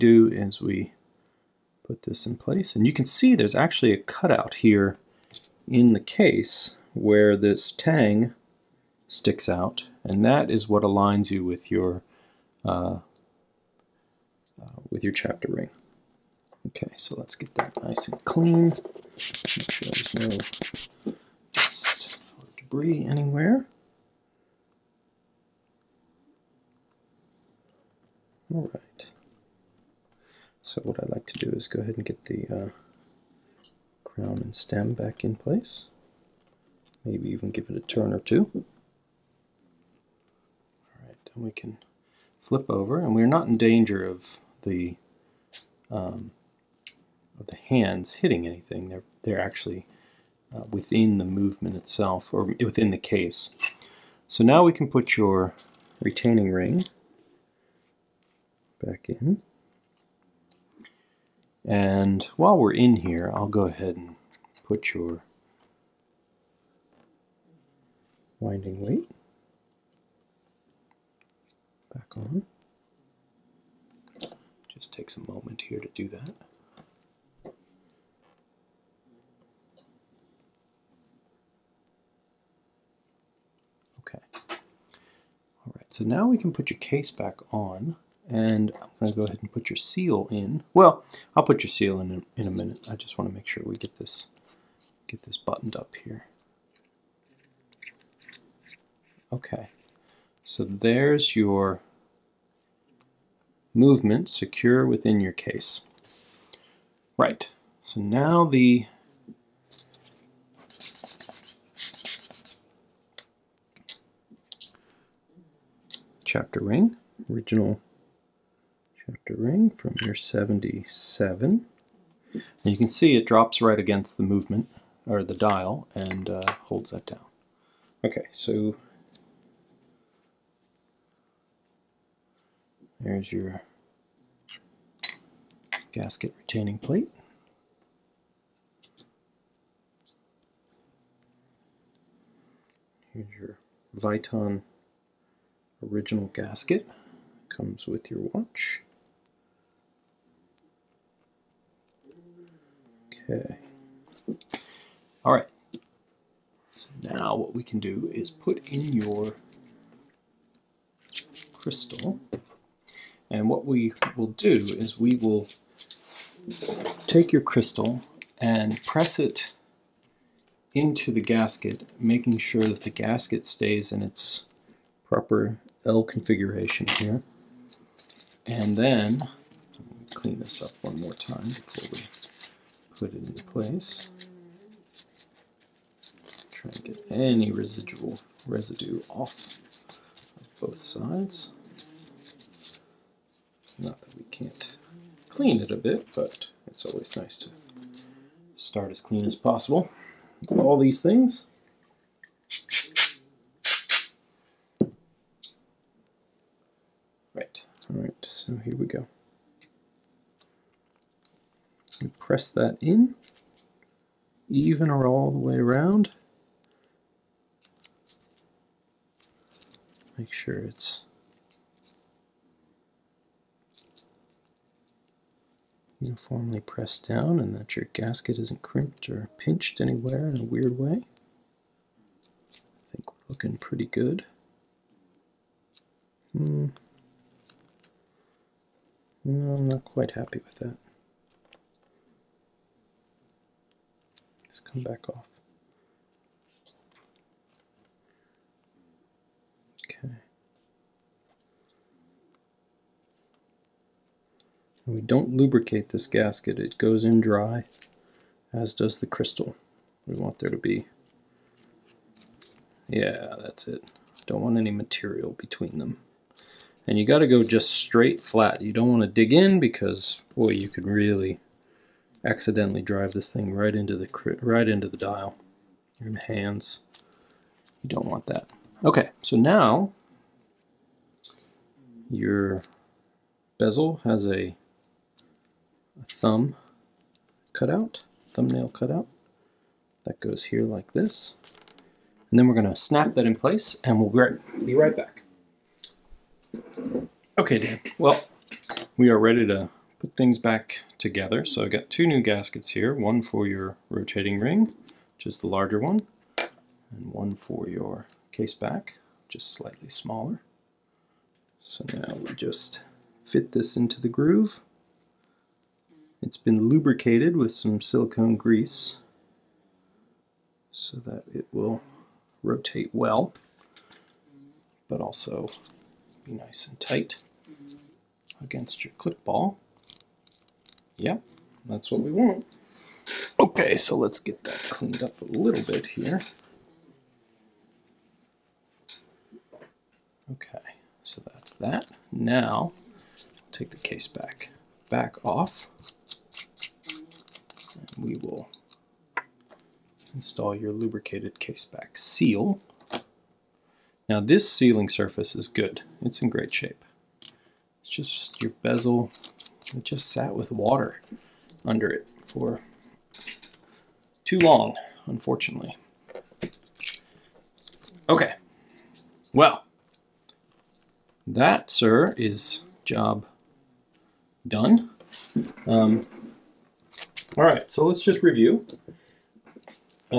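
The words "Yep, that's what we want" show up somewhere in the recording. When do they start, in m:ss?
5:30.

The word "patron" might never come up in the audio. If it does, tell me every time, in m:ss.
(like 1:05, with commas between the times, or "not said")
not said.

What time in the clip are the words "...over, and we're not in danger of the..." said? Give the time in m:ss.
0:42.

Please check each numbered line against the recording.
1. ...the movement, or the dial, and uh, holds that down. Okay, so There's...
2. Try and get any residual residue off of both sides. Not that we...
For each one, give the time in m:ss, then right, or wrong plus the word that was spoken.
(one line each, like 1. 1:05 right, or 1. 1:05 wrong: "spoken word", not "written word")
1. 2:04 right
2. 3:06 right.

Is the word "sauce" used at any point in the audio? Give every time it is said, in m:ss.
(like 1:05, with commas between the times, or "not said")
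not said.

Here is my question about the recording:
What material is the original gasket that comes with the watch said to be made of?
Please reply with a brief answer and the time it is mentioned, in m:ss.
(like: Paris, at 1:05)
Viton, at 2:23.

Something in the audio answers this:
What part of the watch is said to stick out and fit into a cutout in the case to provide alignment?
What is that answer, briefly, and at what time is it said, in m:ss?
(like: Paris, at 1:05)
Tang, at 0:07.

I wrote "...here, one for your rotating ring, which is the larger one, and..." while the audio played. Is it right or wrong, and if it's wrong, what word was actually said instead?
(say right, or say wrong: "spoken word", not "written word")
right.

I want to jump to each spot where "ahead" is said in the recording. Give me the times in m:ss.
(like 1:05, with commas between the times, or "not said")
0:31, 1:03, 1:29.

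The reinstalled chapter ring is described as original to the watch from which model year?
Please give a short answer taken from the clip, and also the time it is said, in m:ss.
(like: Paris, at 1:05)
77, at 2:00.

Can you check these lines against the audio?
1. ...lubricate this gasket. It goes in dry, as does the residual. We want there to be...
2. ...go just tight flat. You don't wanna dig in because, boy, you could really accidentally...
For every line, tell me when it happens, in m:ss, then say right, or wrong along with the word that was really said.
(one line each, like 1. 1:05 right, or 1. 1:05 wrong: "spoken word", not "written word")
1. 4:15 wrong: "crystal", not "residual"
2. 4:27 wrong: "straight", not "tight".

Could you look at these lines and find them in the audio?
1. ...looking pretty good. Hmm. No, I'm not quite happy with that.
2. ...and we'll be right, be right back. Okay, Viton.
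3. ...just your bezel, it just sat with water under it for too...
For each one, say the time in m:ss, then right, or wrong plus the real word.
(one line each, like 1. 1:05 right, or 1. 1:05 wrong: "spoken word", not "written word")
1. 3:53 right
2. 4:53 wrong: "Dan", not "Viton"
3. 5:57 right.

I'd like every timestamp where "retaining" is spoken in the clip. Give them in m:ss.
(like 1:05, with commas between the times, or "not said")
0:55, 2:16.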